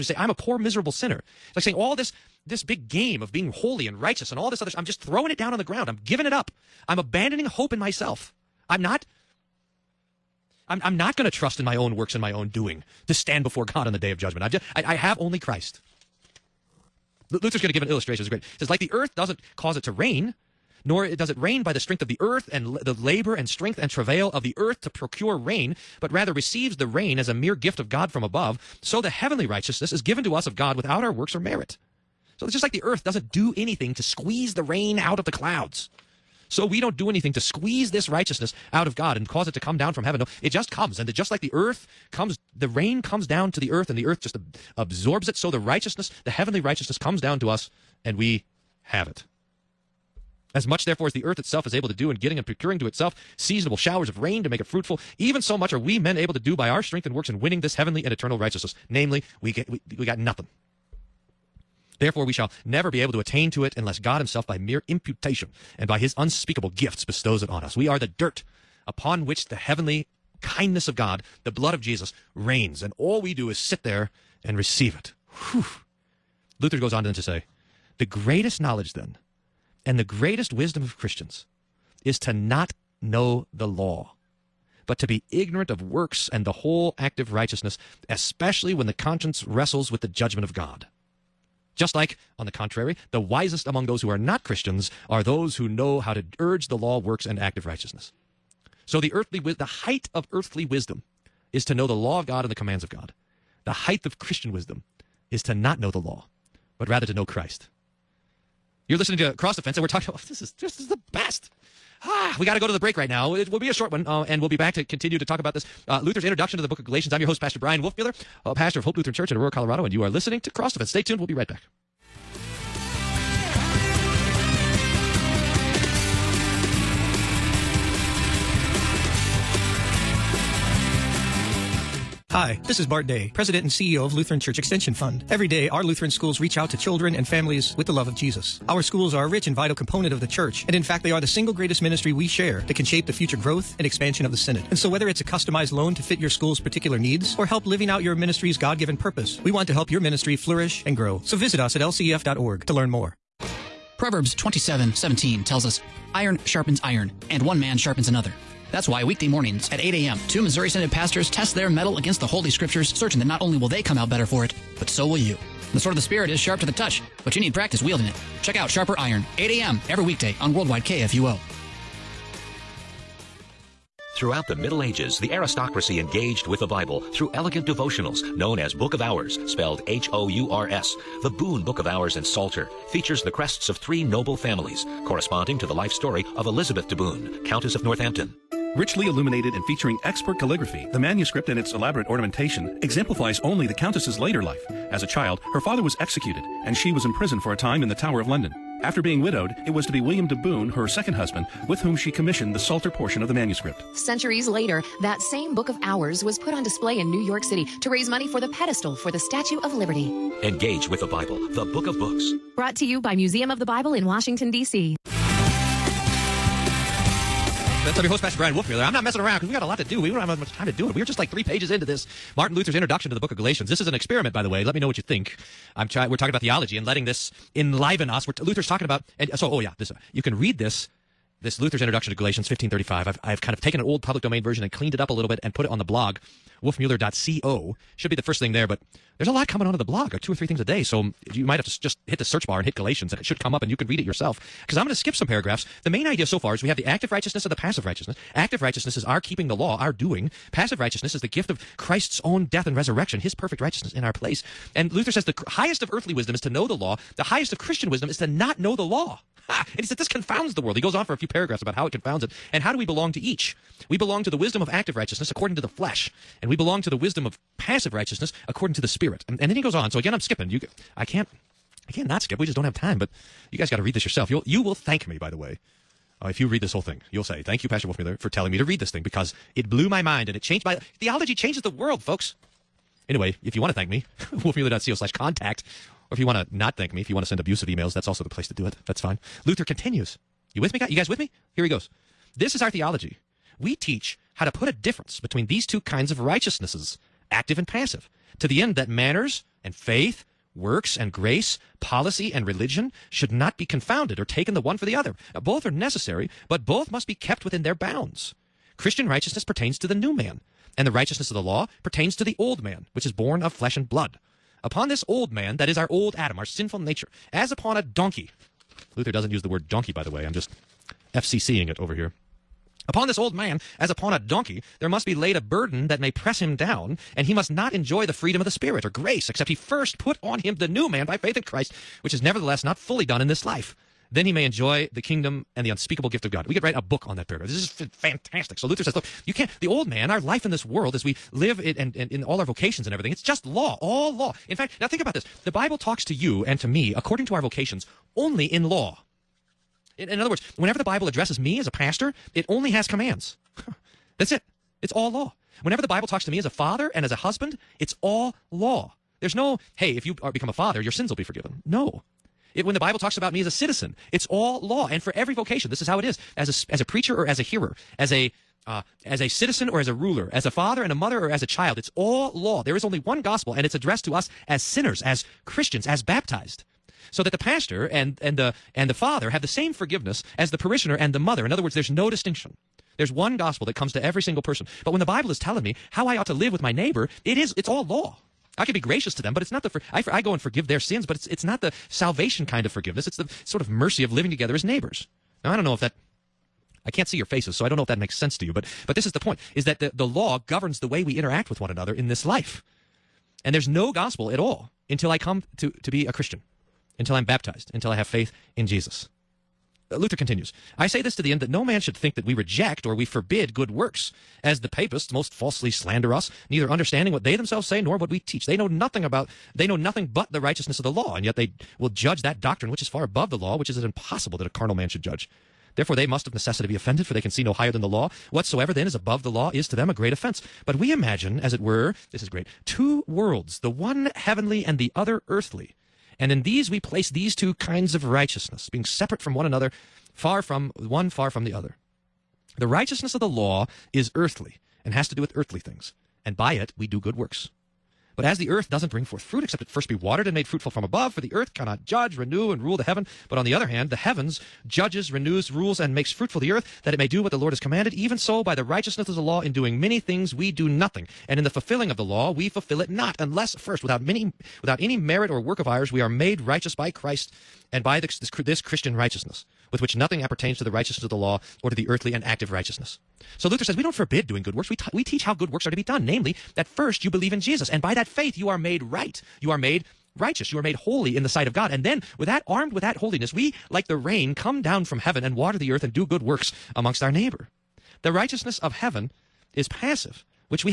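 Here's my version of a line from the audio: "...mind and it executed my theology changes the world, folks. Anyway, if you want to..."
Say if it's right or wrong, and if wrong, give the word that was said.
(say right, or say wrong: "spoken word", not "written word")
wrong: "changed", not "executed".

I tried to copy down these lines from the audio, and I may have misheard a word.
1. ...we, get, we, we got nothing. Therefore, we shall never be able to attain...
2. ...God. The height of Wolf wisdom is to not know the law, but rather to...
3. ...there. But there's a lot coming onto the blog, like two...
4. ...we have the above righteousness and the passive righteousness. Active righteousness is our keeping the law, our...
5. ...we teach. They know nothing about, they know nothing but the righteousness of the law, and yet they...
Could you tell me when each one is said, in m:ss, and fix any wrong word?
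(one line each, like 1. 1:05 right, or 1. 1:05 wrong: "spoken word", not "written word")
1. 0:59 right
2. 1:42 wrong: "Christian", not "Wolf"
3. 3:58 right
4. 4:06 wrong: "active", not "above"
5. 6:58 right.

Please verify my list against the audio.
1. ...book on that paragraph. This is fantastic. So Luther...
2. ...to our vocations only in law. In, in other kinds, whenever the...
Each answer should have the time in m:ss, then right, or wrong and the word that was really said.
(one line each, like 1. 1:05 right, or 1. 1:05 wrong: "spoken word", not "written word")
1. 5:36 right
2. 5:47 wrong: "words", not "kinds".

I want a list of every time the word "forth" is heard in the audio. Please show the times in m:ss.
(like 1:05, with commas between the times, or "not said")
7:29.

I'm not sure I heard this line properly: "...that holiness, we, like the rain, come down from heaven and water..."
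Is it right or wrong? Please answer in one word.
right.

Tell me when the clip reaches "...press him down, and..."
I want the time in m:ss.
5:26.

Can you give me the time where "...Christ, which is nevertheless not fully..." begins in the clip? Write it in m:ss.
5:31.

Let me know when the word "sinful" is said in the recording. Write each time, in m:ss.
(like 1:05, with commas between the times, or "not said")
5:16.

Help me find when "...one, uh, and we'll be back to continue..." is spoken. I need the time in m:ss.
1:53.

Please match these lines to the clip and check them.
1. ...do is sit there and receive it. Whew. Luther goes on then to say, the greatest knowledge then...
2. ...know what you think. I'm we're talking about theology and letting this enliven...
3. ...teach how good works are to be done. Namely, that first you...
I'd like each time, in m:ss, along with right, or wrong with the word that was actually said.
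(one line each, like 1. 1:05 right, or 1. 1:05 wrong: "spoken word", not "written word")
1. 1:13 right
2. 3:44 right
3. 7:55 right.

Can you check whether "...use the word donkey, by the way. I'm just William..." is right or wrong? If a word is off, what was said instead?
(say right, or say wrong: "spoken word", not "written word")
wrong: "FCCing", not "William".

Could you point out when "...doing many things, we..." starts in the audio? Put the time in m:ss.
7:39.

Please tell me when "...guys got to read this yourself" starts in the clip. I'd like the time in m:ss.
4:33.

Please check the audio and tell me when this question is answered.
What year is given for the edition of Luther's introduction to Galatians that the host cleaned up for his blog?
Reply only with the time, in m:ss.
3:52.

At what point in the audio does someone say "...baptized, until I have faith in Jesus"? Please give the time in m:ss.
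6:47.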